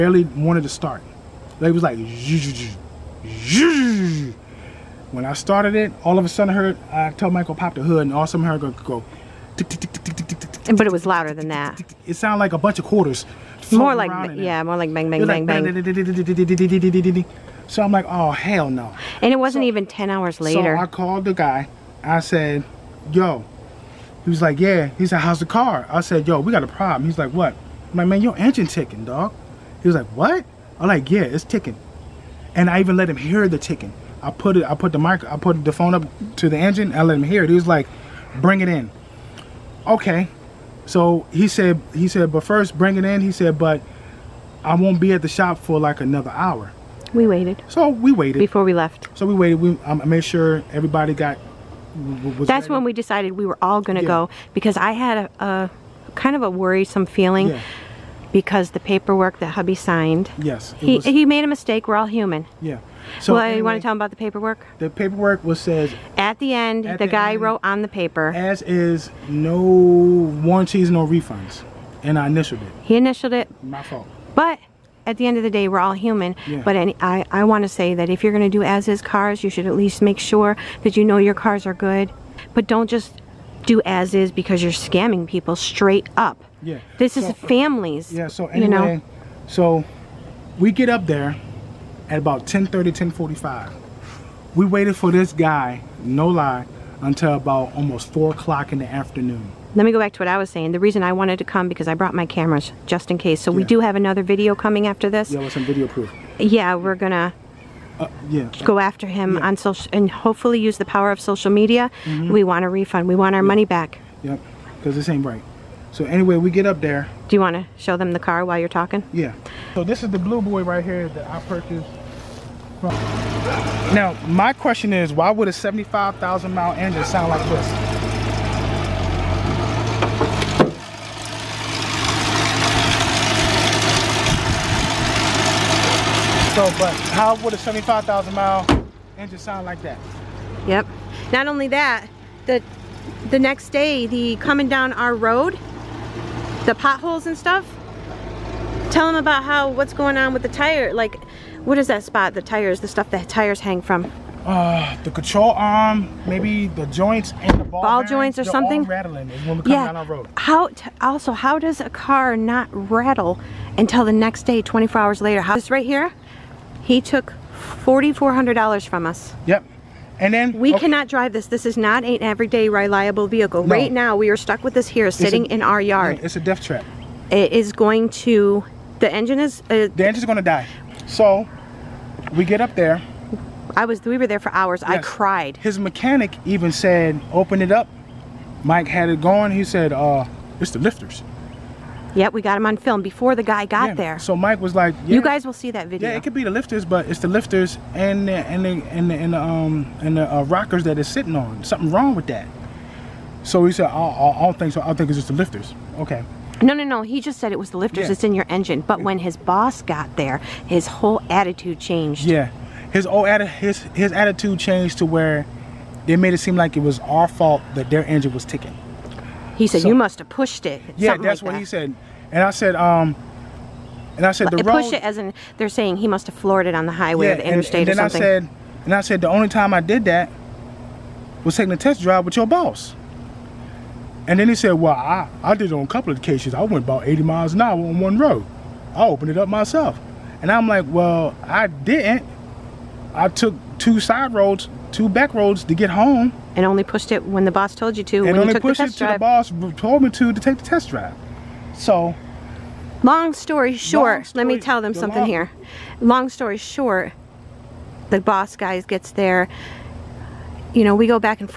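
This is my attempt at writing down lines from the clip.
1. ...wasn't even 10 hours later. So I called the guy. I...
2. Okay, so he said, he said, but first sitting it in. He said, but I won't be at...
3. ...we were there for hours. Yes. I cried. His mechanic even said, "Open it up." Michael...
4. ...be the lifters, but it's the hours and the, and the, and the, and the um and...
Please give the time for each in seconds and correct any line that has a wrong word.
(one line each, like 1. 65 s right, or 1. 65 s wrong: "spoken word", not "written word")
1. 19 s right
2. 39 s wrong: "bring", not "sitting"
3. 184 s wrong: "Mike", not "Michael"
4. 196 s wrong: "lifters", not "hours".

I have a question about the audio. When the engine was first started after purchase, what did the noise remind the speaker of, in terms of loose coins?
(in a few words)
A bunch of quarters.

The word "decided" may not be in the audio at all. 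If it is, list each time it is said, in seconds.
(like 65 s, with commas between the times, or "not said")
52 s.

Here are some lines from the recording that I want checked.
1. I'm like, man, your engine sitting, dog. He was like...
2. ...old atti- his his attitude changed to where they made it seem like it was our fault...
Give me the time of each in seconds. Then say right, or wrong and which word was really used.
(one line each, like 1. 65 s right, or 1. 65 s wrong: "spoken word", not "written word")
1. 27 s wrong: "ticking", not "sitting"
2. 213 s right.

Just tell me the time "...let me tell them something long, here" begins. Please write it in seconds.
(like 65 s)
254 s.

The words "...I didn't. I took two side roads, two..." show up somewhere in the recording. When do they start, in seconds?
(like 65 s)
241 s.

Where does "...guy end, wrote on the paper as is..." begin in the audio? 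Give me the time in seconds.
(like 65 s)
67 s.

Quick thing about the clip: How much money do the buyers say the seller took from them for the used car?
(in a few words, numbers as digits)
$4,400.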